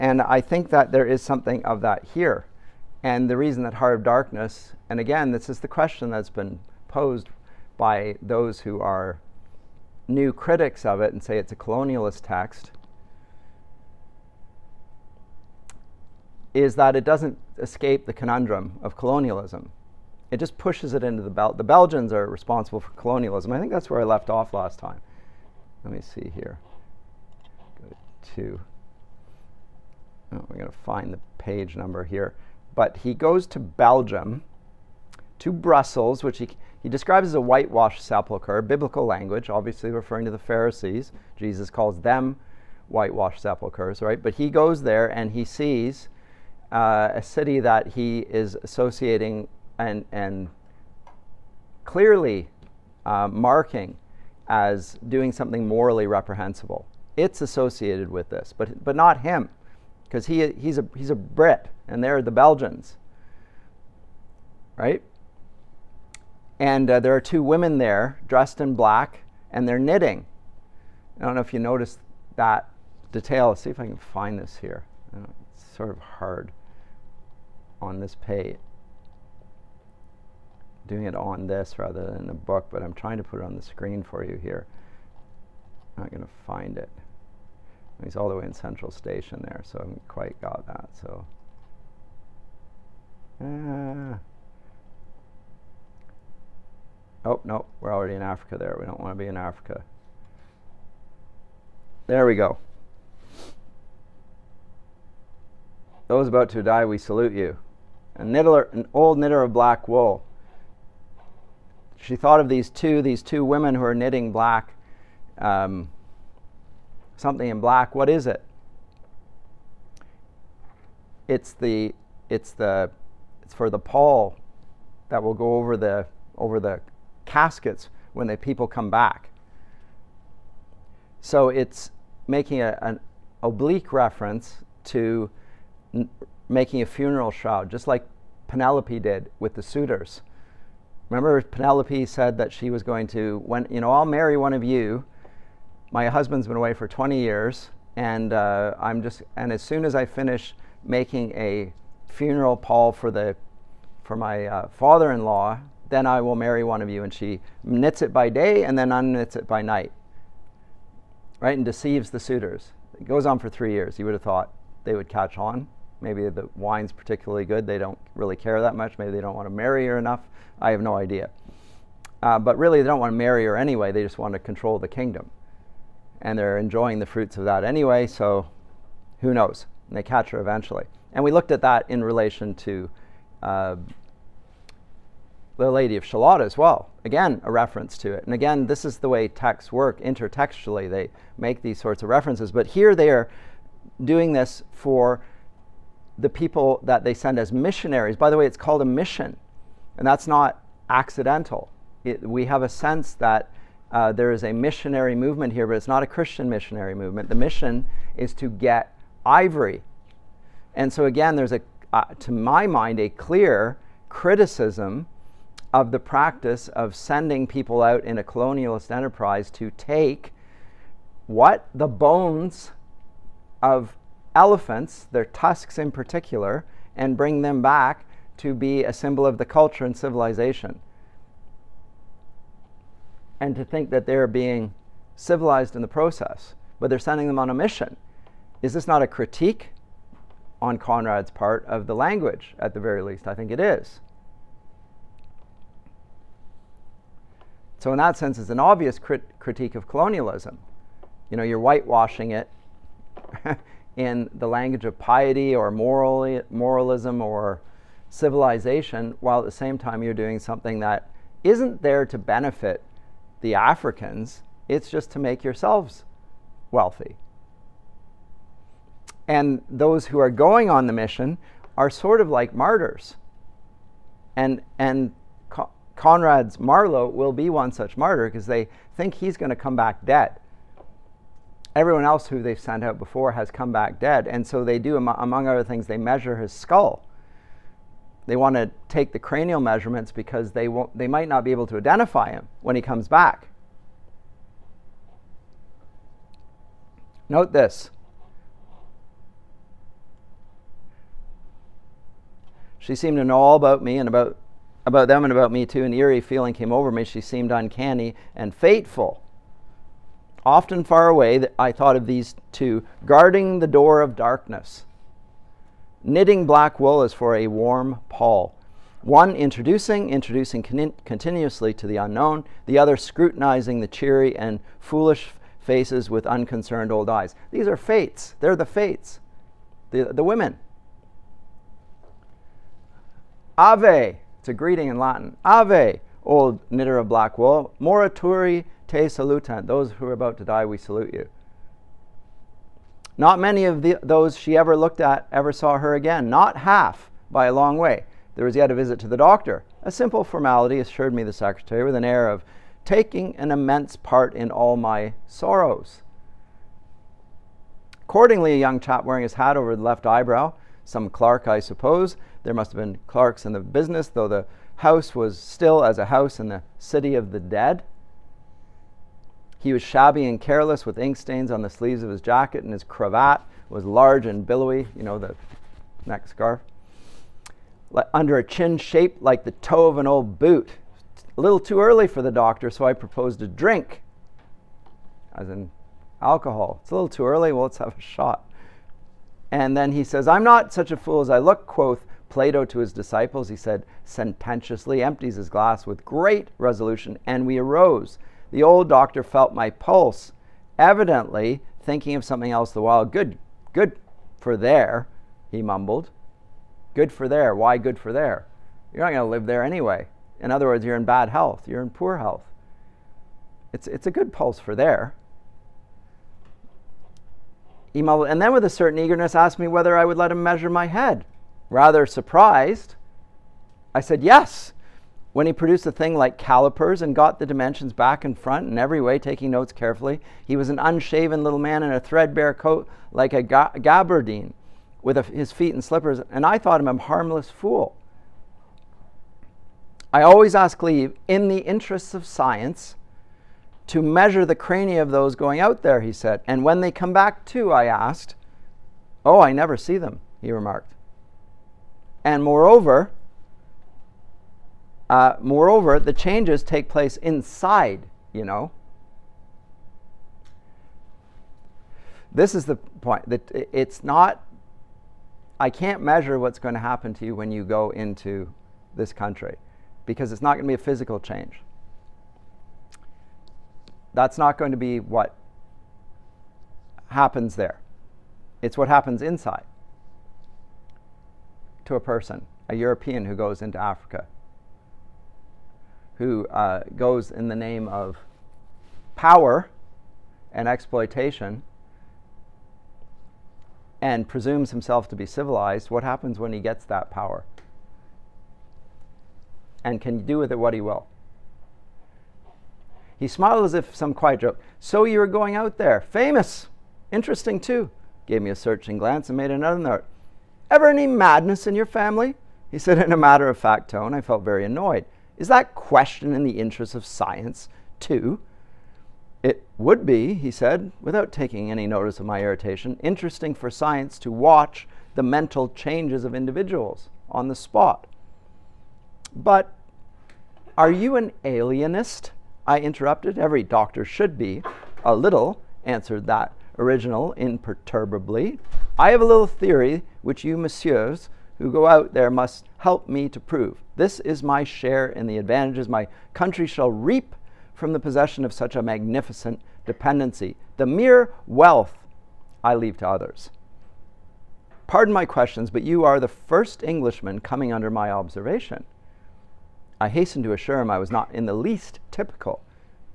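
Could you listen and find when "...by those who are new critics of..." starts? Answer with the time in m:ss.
0:07.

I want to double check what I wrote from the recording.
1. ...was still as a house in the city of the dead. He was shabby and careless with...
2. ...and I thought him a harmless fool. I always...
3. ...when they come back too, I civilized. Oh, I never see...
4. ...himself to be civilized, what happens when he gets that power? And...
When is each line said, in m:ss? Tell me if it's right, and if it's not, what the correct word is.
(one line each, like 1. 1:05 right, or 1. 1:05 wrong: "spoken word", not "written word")
1. 6:05 right
2. 7:16 right
3. 7:26 wrong: "asked", not "civilized"
4. 8:14 right.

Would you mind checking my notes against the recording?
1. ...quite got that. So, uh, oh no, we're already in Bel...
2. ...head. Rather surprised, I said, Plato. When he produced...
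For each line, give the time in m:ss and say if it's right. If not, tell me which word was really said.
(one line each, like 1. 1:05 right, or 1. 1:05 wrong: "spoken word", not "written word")
1. 1:30 wrong: "Africa", not "Bel"
2. 7:00 wrong: "Yes", not "Plato".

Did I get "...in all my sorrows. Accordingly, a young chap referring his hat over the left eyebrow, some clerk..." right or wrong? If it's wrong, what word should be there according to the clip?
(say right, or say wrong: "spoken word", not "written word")
wrong: "wearing", not "referring".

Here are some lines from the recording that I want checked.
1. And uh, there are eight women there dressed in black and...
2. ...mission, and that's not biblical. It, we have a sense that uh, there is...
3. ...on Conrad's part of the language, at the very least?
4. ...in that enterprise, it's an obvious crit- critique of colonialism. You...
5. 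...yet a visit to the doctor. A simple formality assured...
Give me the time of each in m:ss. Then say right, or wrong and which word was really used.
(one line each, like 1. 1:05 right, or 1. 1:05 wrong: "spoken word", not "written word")
1. 1:06 wrong: "two", not "eight"
2. 3:18 wrong: "accidental", not "biblical"
3. 4:00 right
4. 4:07 wrong: "sense", not "enterprise"
5. 5:48 right.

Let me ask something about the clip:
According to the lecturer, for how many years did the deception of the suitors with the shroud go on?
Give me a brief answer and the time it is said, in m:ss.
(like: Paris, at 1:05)
3, at 2:43.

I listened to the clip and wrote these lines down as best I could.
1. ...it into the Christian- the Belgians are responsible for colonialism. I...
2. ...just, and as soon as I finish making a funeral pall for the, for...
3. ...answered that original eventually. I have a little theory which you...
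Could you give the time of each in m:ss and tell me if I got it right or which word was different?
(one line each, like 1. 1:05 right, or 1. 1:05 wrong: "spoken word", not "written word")
1. 0:20 wrong: "Bel", not "Christian"
2. 2:29 right
3. 8:55 wrong: "imperturbably", not "eventually".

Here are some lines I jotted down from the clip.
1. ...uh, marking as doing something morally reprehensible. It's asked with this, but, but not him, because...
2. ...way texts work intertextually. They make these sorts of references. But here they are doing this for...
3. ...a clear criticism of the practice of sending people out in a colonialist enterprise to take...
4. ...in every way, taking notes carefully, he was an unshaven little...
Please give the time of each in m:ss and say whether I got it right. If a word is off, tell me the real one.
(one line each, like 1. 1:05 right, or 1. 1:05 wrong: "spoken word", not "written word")
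1. 0:53 wrong: "associated", not "asked"
2. 3:09 right
3. 3:32 right
4. 7:08 right.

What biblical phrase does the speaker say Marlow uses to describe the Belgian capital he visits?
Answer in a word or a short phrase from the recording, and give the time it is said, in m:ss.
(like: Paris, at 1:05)
whitewashed sepulchre, at 0:37.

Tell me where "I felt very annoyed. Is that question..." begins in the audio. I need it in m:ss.
8:34.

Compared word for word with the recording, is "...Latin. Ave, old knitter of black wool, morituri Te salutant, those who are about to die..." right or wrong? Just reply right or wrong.
right.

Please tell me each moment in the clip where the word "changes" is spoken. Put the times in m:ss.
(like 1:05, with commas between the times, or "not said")
7:36, 7:51, 8:45.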